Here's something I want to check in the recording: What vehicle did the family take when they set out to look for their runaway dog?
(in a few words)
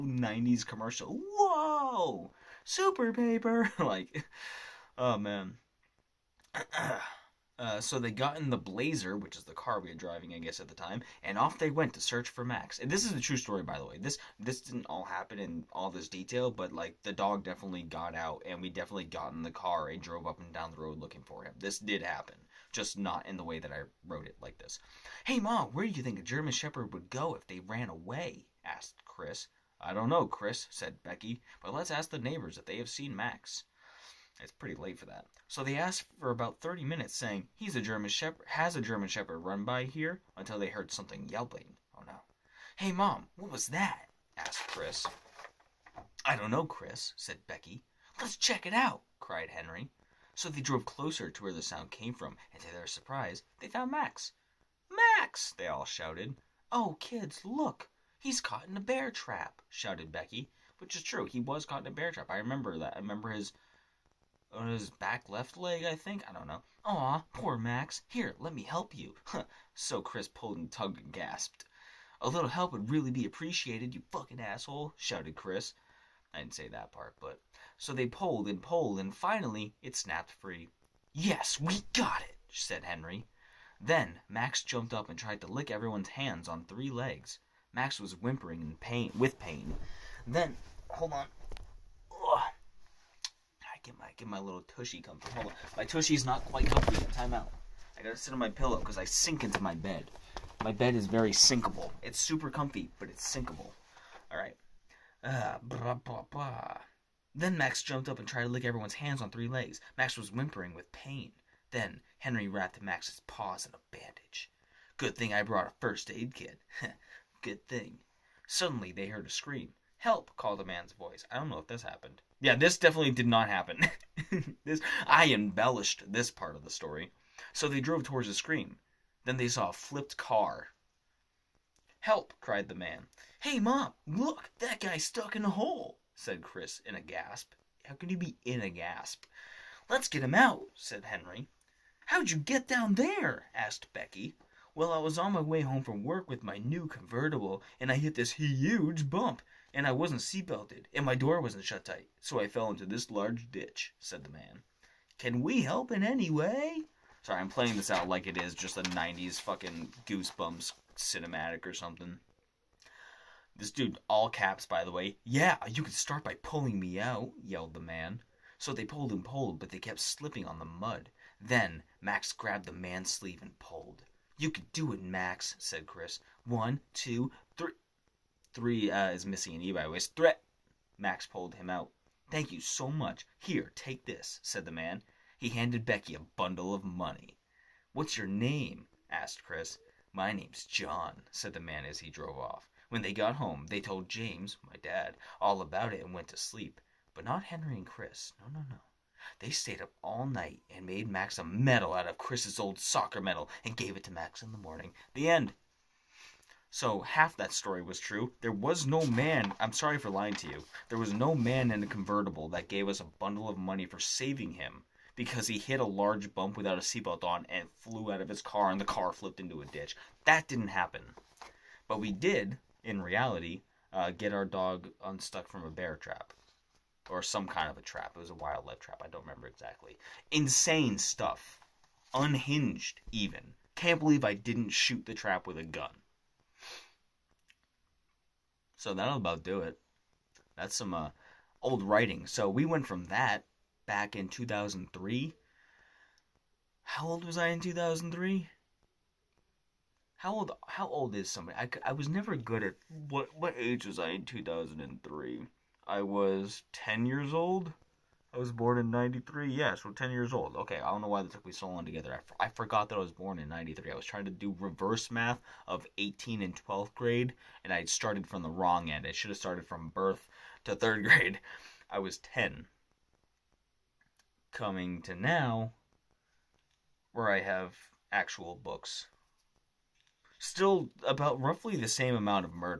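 Blazer.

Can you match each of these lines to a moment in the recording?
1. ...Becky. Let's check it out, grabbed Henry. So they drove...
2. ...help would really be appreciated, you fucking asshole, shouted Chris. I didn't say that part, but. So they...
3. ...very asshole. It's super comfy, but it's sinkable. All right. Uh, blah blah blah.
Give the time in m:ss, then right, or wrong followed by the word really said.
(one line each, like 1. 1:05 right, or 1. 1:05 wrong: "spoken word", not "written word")
1. 0:47 wrong: "cried", not "grabbed"
2. 1:12 right
3. 1:41 wrong: "sinkable", not "asshole".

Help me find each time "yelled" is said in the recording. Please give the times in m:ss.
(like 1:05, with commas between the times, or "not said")
2:47.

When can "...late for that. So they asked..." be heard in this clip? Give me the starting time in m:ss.
0:34.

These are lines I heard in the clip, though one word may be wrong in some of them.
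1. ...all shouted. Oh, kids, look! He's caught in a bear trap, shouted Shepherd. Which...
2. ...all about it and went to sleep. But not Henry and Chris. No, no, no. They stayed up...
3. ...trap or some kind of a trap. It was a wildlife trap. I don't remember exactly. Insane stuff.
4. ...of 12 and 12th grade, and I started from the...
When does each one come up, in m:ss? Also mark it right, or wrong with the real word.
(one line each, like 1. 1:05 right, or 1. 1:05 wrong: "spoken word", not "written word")
1. 0:55 wrong: "Becky", not "Shepherd"
2. 3:15 right
3. 3:45 right
4. 4:25 wrong: "18", not "12".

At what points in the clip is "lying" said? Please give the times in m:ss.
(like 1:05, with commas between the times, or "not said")
3:30.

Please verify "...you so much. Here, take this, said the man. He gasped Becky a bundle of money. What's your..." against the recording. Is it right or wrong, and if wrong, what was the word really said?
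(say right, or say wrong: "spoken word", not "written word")
wrong: "handed", not "gasped".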